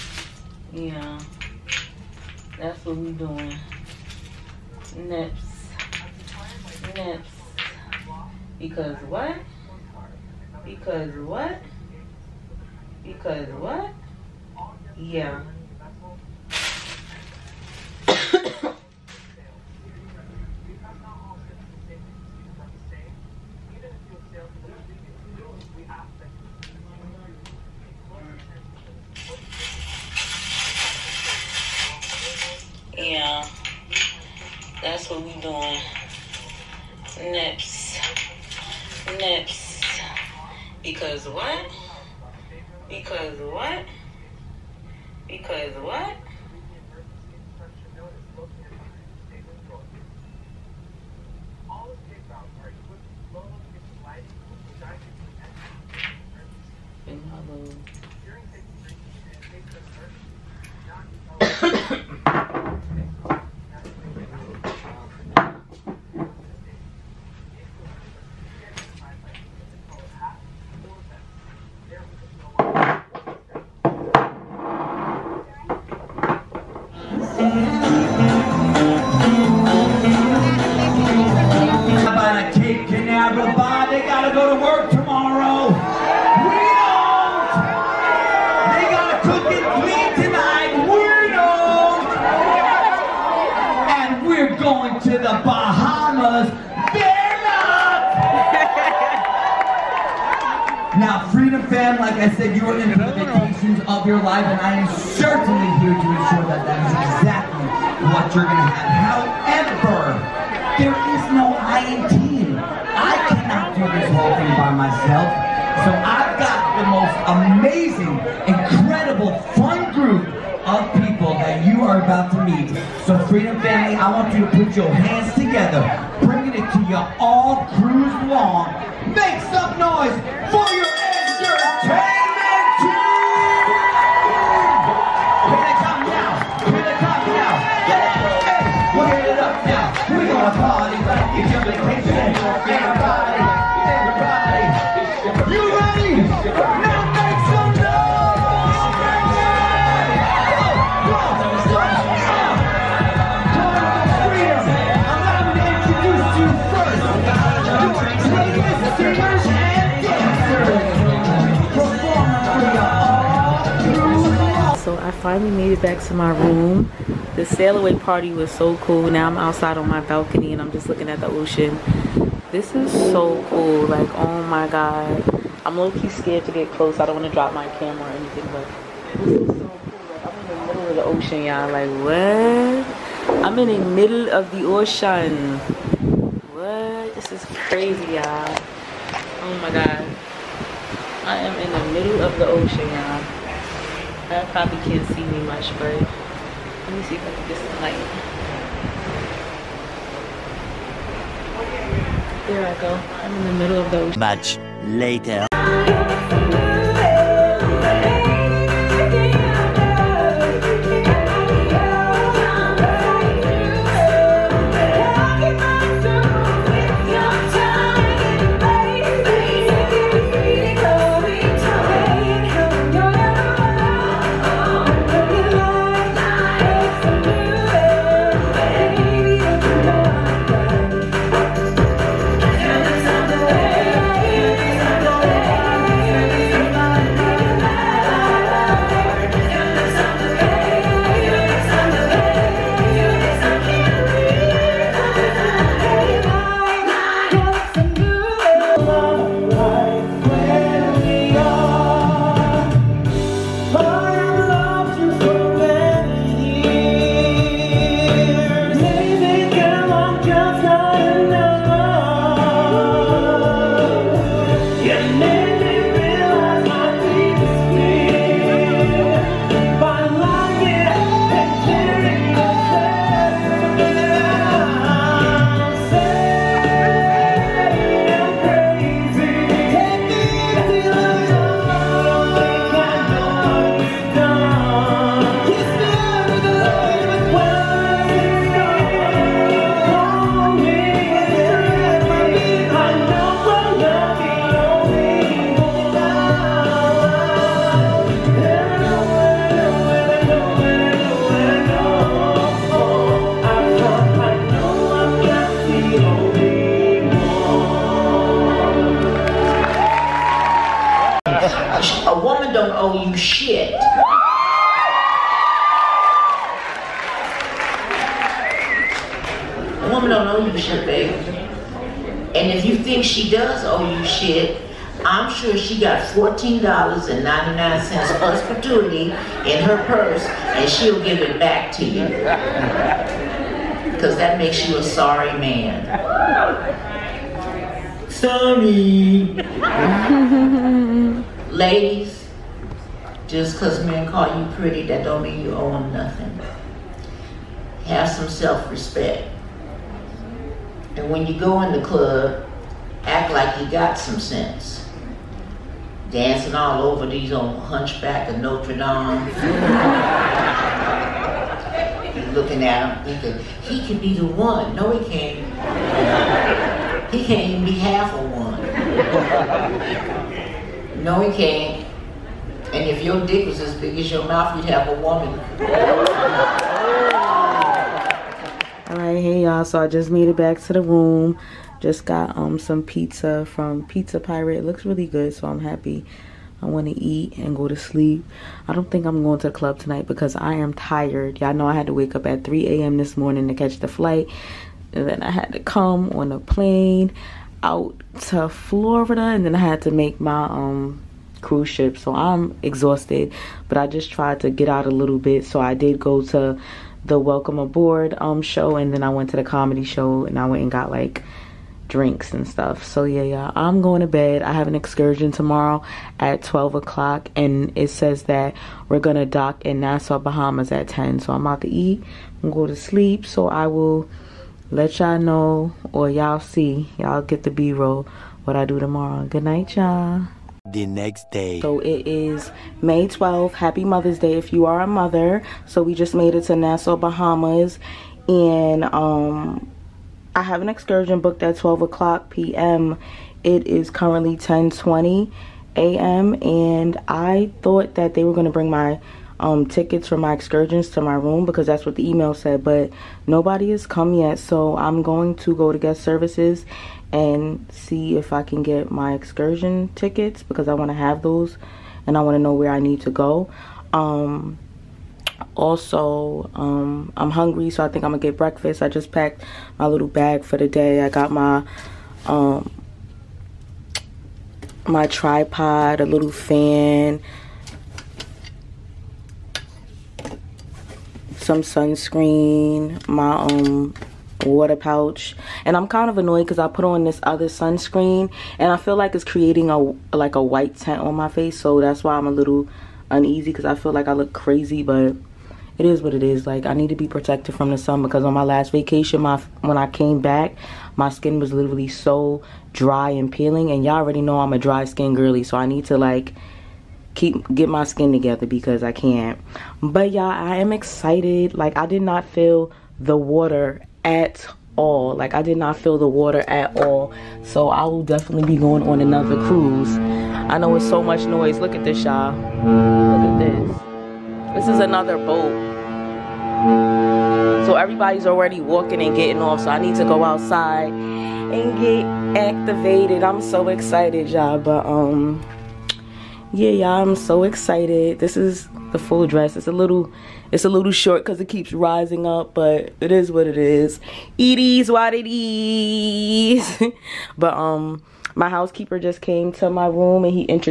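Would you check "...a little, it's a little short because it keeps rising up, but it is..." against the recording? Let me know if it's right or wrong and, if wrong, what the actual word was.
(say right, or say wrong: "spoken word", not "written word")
right.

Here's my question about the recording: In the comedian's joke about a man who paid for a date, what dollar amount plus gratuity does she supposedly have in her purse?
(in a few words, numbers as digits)
$14.99.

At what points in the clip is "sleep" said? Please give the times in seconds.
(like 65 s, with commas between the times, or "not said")
387 s, 422 s.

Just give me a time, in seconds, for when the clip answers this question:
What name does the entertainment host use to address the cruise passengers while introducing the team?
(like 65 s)
123 s.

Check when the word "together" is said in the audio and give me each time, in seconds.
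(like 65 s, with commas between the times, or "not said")
125 s, 508 s.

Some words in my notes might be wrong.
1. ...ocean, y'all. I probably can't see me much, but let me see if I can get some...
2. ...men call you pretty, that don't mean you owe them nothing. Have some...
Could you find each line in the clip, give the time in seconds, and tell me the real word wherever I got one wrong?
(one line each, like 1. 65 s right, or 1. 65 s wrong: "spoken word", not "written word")
1. 192 s right
2. 343 s right.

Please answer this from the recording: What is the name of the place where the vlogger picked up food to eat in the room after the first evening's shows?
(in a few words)
Pizza Pirate.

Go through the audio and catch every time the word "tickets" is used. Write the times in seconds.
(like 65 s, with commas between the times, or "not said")
449 s, 459 s.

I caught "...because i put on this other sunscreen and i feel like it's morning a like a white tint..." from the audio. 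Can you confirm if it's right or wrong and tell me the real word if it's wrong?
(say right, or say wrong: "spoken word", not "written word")
wrong: "creating", not "morning".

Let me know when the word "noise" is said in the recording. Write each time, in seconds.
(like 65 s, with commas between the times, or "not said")
129 s, 521 s.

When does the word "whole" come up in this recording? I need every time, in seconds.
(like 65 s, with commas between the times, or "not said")
114 s.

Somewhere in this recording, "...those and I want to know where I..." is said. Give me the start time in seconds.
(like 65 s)
461 s.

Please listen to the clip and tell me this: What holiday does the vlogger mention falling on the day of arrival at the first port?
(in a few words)
Mother's Day.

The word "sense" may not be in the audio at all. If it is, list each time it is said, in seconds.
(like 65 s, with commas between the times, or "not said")
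354 s.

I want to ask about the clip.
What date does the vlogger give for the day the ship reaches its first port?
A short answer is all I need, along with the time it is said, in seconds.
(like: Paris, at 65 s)
May 12, at 432 s.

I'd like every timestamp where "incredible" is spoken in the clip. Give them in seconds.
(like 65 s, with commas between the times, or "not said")
118 s.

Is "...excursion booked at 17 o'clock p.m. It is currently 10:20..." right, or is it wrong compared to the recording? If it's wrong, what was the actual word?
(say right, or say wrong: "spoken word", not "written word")
wrong: "12", not "17".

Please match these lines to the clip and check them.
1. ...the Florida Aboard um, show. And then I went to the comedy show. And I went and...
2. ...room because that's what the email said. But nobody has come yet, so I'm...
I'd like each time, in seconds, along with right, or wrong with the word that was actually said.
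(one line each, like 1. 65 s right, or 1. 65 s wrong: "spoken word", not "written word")
1. 407 s wrong: "Welcome", not "Florida"
2. 451 s right.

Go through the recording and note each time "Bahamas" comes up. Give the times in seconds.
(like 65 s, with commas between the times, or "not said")
420 s, 436 s.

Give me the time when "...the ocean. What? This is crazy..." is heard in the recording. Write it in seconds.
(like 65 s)
184 s.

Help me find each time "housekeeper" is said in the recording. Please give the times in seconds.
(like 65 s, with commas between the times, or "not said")
548 s.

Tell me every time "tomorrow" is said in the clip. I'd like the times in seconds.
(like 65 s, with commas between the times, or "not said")
415 s, 428 s.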